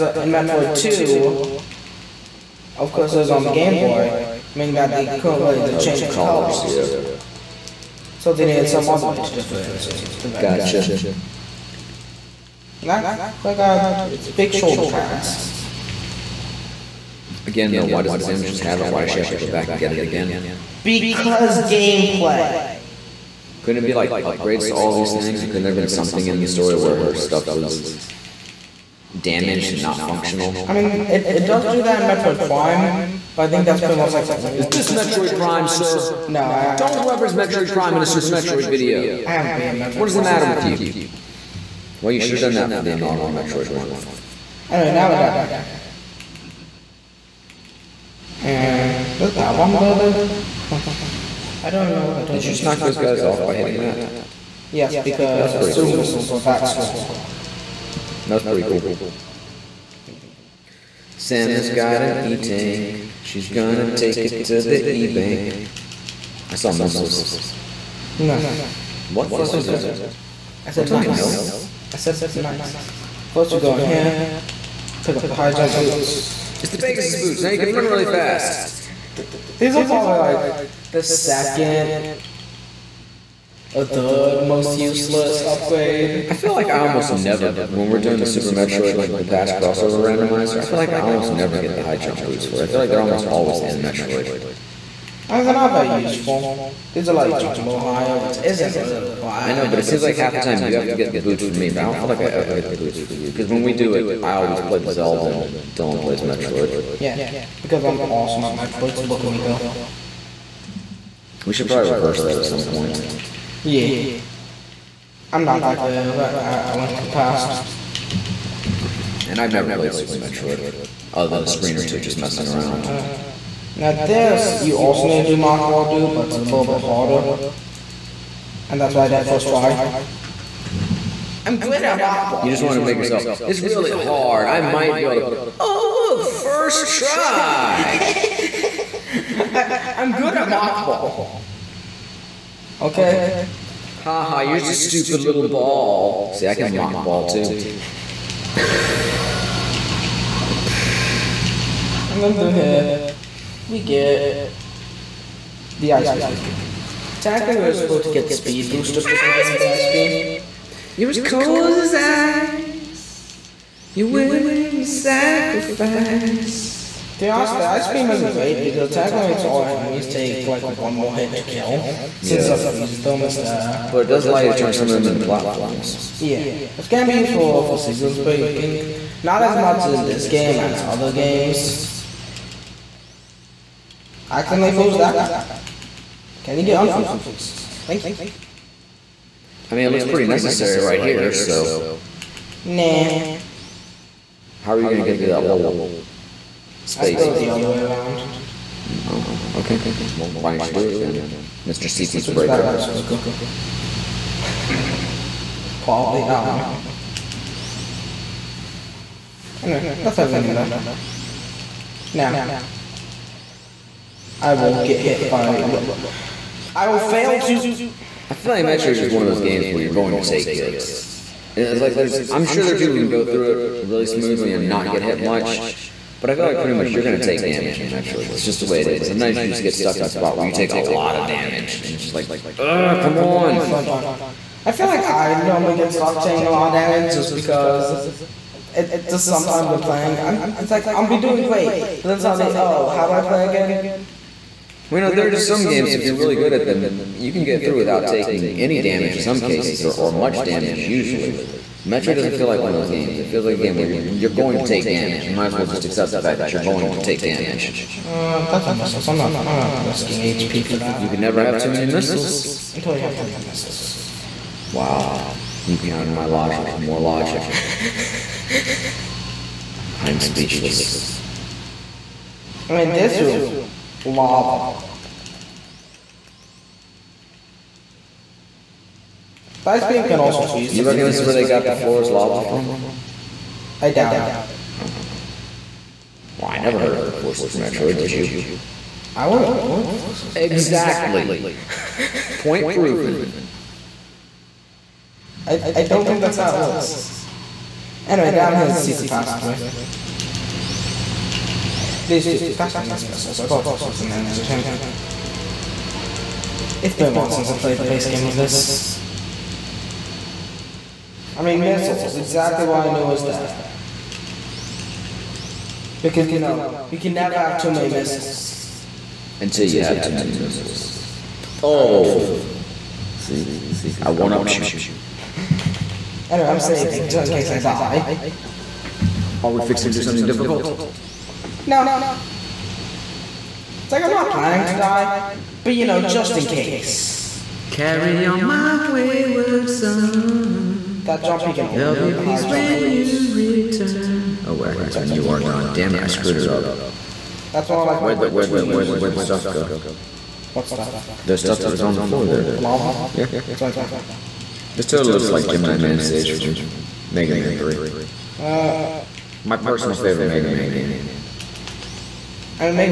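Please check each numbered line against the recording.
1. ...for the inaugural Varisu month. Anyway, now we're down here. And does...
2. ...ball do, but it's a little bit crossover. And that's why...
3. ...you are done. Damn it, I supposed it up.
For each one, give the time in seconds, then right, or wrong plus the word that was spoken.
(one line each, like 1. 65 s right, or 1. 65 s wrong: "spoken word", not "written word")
1. 42 s wrong: "Metroid", not "Varisu"
2. 125 s wrong: "harder", not "crossover"
3. 345 s wrong: "screwed", not "supposed".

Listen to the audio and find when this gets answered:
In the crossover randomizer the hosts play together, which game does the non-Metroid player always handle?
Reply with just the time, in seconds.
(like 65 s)
104 s.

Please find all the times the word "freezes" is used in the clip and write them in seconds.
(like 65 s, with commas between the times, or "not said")
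172 s, 280 s.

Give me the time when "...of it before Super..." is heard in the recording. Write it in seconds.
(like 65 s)
286 s.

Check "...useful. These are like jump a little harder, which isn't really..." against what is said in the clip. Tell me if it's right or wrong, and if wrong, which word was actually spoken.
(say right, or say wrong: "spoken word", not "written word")
wrong: "higher", not "harder".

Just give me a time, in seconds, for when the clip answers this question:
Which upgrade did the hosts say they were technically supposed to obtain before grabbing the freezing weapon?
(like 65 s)
158 s.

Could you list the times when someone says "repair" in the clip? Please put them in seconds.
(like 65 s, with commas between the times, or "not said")
not said.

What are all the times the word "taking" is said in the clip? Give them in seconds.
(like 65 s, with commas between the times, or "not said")
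236 s, 248 s.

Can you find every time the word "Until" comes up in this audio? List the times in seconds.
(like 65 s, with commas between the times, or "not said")
262 s, 319 s.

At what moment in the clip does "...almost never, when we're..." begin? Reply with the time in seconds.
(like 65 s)
86 s.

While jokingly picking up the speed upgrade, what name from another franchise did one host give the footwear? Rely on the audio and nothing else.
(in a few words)
Pegasus boots.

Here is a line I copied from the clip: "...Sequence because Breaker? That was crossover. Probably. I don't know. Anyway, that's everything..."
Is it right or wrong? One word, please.
wrong.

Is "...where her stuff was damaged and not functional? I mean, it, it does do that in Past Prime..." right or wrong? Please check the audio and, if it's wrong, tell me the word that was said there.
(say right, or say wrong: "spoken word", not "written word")
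wrong: "Metroid", not "Past".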